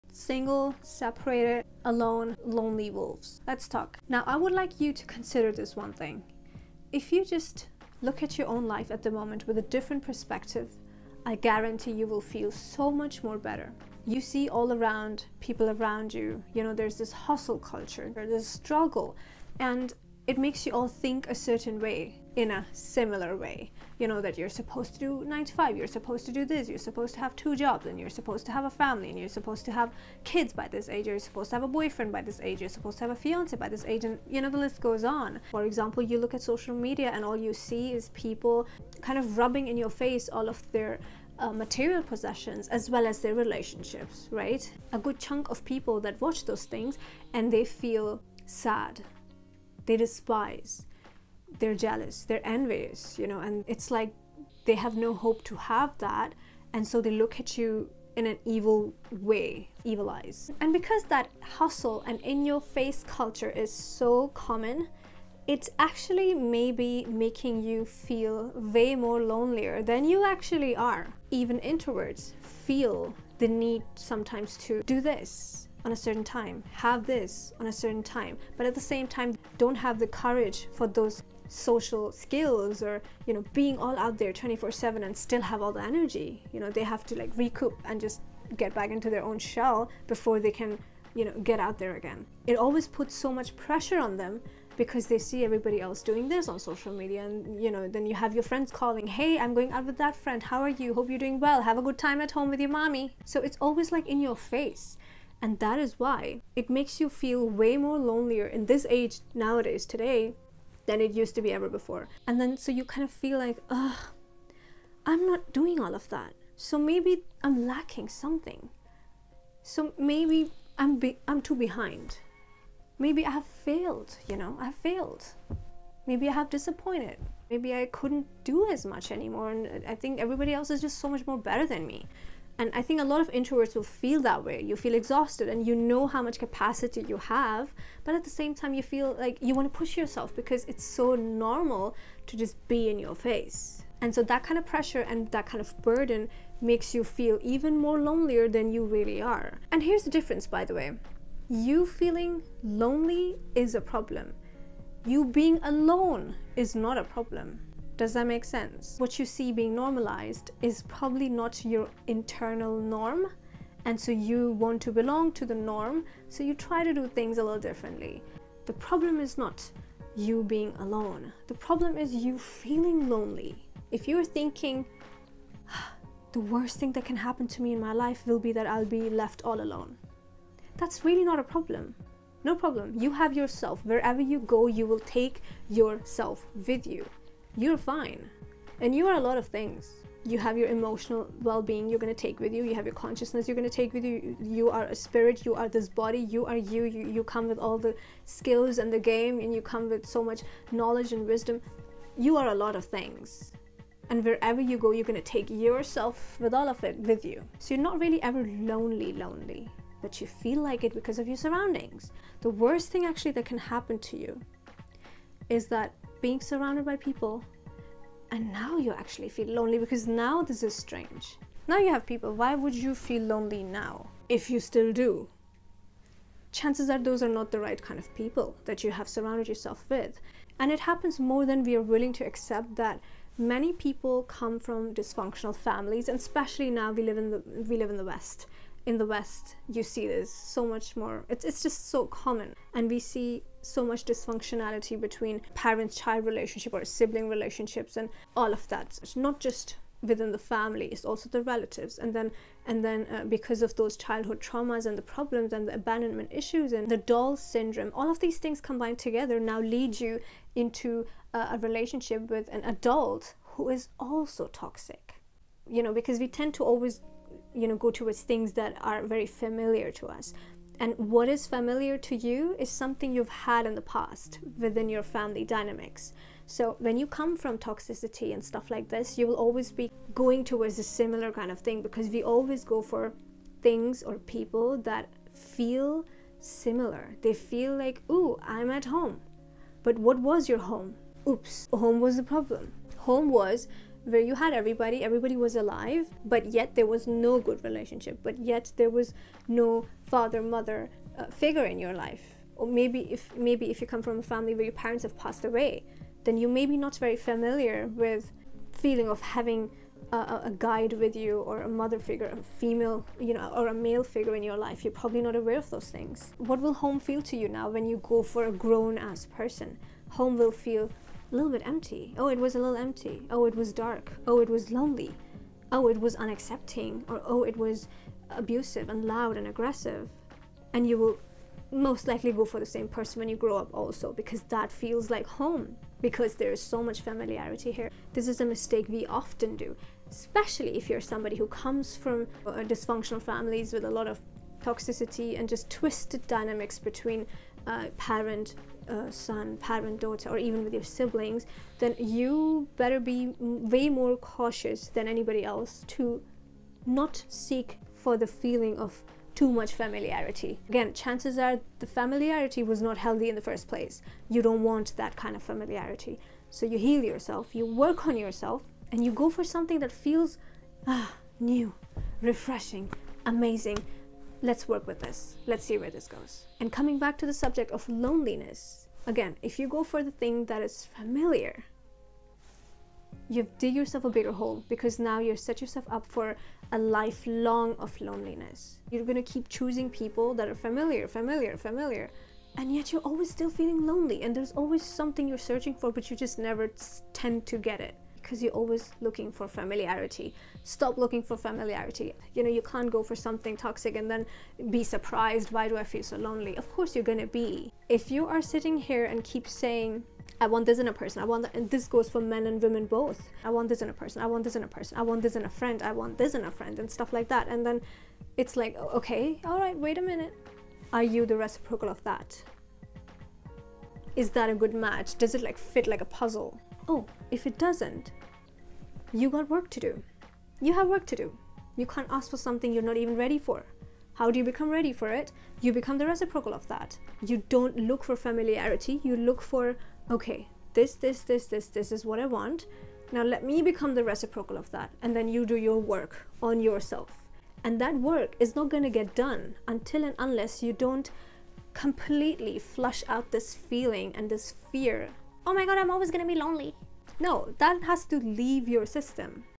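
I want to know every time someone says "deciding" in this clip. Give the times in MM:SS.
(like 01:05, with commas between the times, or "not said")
not said.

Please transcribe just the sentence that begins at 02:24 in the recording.
And so that kind of pressure and that kind of burden makes you feel even more lonelier than you really are.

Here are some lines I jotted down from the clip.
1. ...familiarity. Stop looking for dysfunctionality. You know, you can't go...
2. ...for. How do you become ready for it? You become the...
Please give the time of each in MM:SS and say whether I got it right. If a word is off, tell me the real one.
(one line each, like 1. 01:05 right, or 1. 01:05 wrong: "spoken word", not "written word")
1. 06:39 wrong: "familiarity", not "dysfunctionality"
2. 07:13 right.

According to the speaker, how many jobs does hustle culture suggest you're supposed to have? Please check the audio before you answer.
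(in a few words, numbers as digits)
2.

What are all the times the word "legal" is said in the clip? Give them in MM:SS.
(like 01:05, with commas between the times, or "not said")
not said.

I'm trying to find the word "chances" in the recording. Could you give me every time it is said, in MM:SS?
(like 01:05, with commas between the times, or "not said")
03:46, 06:00.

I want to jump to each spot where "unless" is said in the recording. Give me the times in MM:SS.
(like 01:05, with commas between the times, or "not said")
07:30.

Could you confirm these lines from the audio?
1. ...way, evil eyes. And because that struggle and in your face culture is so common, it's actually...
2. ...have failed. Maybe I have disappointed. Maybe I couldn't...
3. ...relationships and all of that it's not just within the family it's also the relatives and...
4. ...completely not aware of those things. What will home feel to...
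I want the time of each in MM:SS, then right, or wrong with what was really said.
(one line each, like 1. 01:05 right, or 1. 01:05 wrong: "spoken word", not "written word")
1. 00:59 wrong: "hustle", not "struggle"
2. 02:04 right
3. 04:07 right
4. 05:14 wrong: "probably", not "completely".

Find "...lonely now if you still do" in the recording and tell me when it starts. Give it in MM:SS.
03:43.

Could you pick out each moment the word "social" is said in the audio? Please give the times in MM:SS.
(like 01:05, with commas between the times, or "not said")
00:36, 01:21, 01:36.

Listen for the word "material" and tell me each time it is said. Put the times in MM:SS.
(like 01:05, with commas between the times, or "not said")
00:41.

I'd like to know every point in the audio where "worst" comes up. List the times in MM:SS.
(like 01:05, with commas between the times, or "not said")
02:56, 03:32.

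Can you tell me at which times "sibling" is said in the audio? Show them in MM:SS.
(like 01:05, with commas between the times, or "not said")
04:06, 05:50.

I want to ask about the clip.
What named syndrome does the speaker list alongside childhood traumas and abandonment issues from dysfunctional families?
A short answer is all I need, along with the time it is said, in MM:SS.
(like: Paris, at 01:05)
Doll syndrome, at 04:16.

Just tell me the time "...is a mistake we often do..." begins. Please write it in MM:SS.
05:38.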